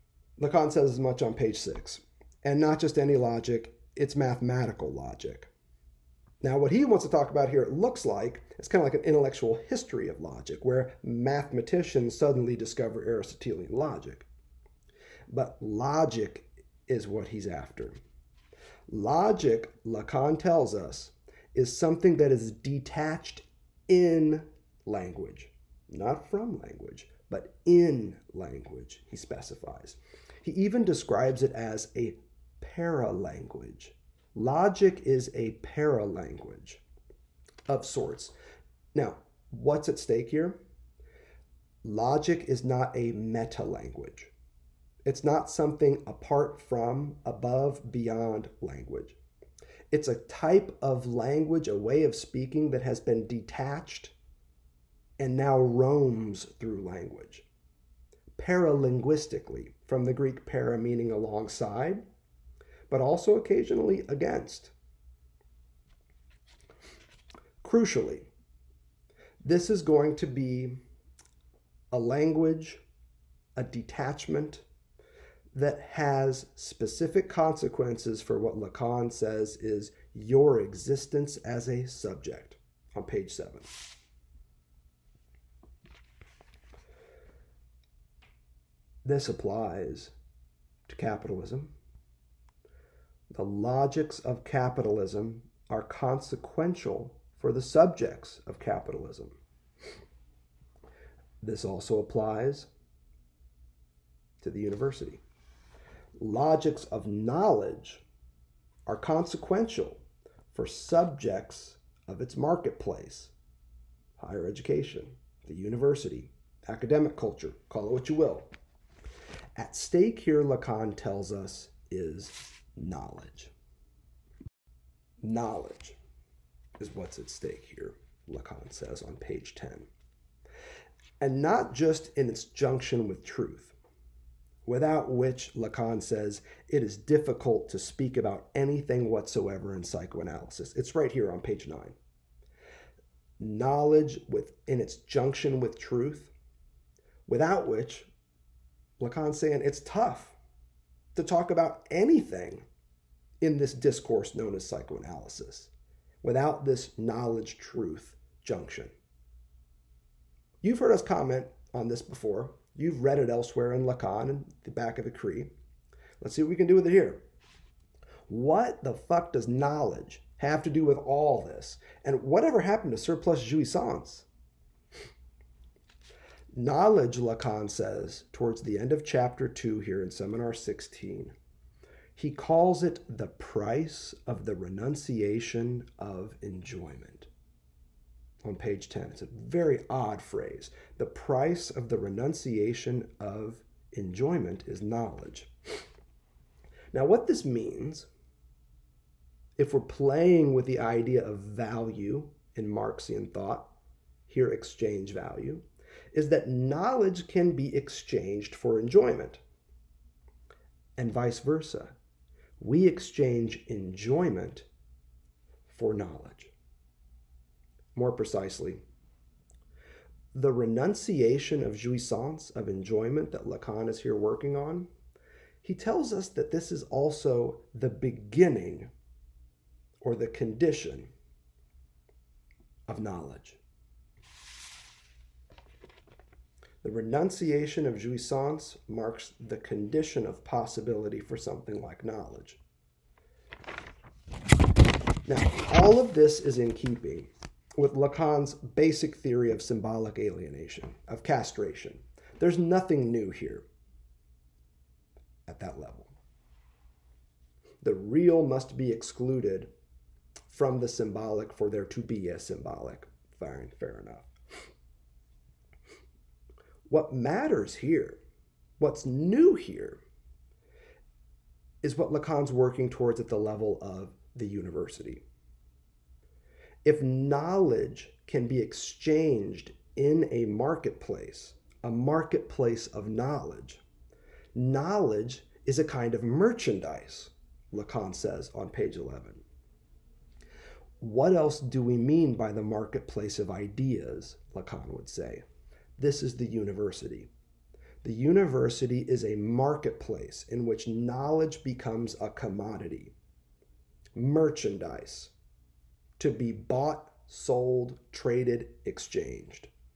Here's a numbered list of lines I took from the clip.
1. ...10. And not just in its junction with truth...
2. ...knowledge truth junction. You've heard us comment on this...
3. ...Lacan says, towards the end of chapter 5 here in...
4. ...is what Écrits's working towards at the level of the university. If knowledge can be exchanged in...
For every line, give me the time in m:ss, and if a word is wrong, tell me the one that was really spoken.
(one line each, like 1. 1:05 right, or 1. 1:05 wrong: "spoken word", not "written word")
1. 2:09 right
2. 2:36 right
3. 2:57 wrong: "2", not "5"
4. 4:31 wrong: "Lacan", not "Écrits".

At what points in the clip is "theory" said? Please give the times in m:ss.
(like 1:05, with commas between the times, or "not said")
4:09.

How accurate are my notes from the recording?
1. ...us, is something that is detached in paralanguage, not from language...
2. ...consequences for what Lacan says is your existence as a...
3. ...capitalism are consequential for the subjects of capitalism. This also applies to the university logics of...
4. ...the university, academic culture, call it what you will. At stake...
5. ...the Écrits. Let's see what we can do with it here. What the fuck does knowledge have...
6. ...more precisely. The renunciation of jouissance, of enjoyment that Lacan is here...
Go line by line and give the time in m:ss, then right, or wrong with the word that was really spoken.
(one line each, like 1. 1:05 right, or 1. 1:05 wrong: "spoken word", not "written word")
1. 0:20 wrong: "language", not "paralanguage"
2. 1:17 right
3. 1:34 right
4. 1:55 right
5. 2:45 right
6. 3:37 right.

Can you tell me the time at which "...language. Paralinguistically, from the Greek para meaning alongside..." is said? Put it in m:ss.
0:56.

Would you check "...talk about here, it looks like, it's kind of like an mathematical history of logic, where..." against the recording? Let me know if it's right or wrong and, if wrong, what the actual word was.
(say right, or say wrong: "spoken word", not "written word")
wrong: "intellectual", not "mathematical".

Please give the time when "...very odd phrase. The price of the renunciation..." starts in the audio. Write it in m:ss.
3:09.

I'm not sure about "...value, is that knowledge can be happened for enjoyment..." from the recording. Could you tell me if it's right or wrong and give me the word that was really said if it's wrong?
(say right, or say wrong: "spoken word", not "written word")
wrong: "exchanged", not "happened".